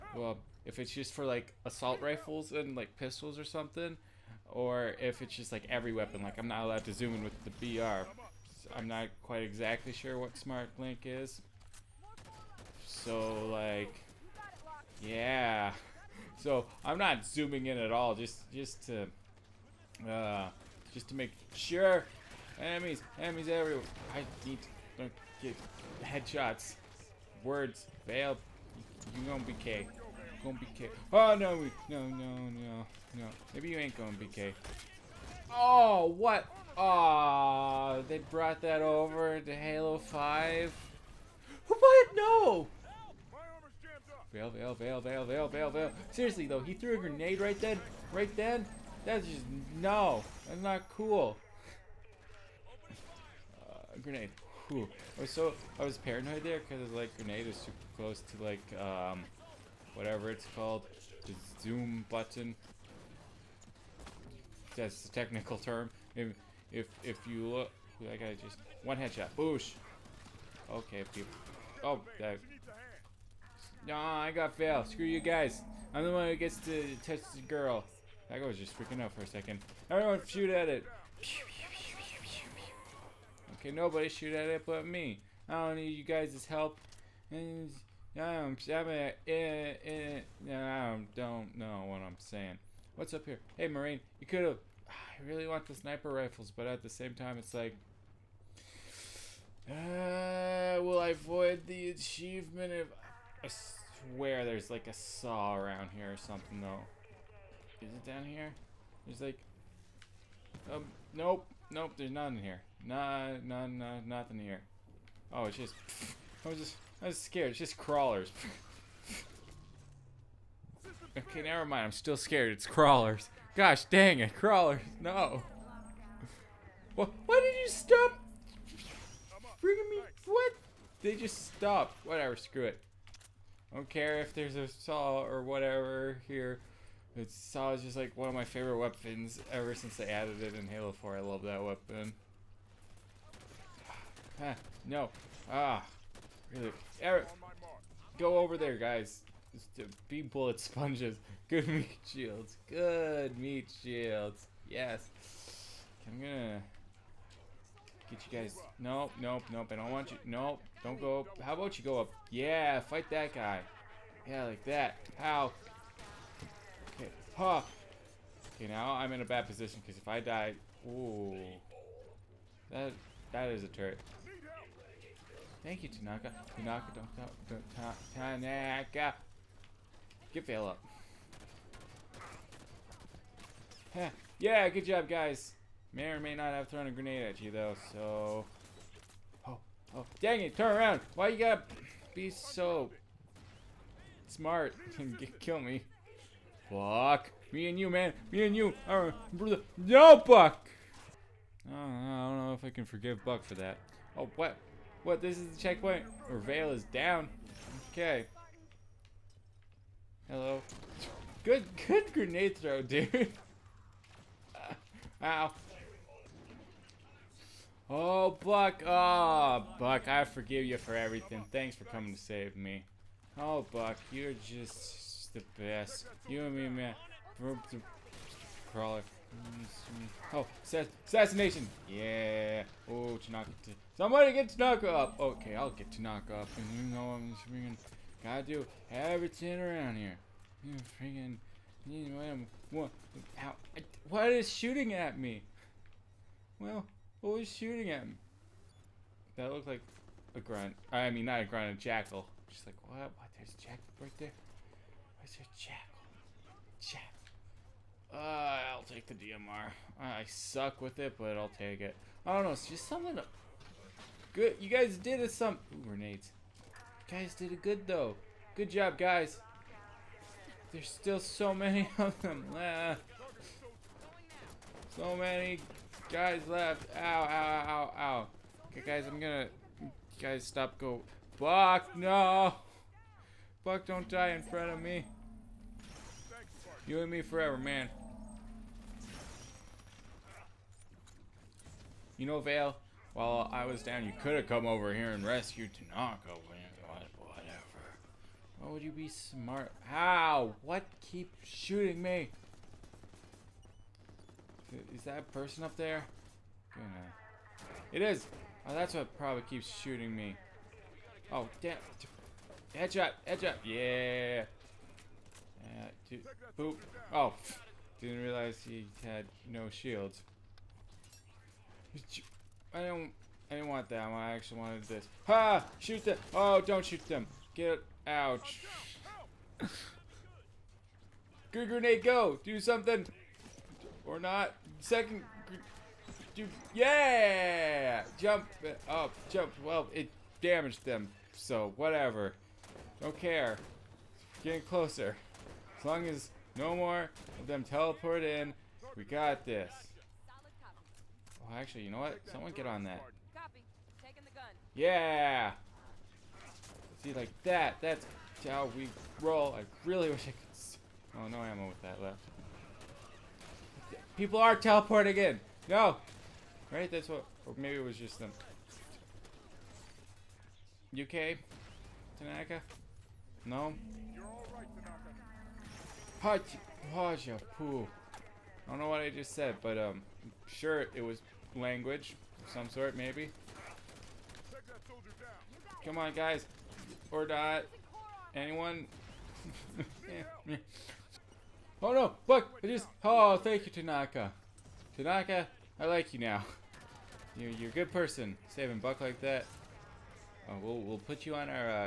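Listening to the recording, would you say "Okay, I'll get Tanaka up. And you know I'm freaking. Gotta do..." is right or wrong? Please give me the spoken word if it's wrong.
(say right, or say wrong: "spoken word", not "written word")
right.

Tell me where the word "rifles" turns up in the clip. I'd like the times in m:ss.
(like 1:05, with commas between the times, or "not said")
0:02, 1:36.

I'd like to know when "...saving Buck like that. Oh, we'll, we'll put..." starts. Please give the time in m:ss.
6:38.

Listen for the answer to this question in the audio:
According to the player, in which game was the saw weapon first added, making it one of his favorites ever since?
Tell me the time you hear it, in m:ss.
2:20.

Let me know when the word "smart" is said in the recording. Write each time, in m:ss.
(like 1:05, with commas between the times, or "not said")
0:10, 3:14, 4:59.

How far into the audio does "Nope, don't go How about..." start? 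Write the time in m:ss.
2:40.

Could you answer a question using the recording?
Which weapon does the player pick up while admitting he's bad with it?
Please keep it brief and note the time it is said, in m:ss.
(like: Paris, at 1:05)
DMR, at 4:19.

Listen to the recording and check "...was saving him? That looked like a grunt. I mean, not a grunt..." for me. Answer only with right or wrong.
wrong.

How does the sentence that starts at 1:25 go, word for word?
I don't need you guys' help.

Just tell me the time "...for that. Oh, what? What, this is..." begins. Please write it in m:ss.
3:23.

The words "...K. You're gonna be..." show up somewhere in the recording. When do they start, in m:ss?
0:29.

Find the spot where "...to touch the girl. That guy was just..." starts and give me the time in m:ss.
1:16.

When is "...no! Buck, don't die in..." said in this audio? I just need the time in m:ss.
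4:41.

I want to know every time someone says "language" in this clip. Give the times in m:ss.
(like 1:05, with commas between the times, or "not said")
6:21.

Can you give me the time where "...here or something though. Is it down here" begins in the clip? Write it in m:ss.
1:45.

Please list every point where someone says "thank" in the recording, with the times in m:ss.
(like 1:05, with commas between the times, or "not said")
2:55, 3:41, 6:33.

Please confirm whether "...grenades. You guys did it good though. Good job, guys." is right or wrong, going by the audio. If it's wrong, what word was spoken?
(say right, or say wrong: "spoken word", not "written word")
right.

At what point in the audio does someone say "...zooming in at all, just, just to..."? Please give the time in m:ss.
0:17.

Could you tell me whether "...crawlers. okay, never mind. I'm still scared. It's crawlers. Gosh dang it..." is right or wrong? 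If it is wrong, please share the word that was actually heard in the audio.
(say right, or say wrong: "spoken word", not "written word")
right.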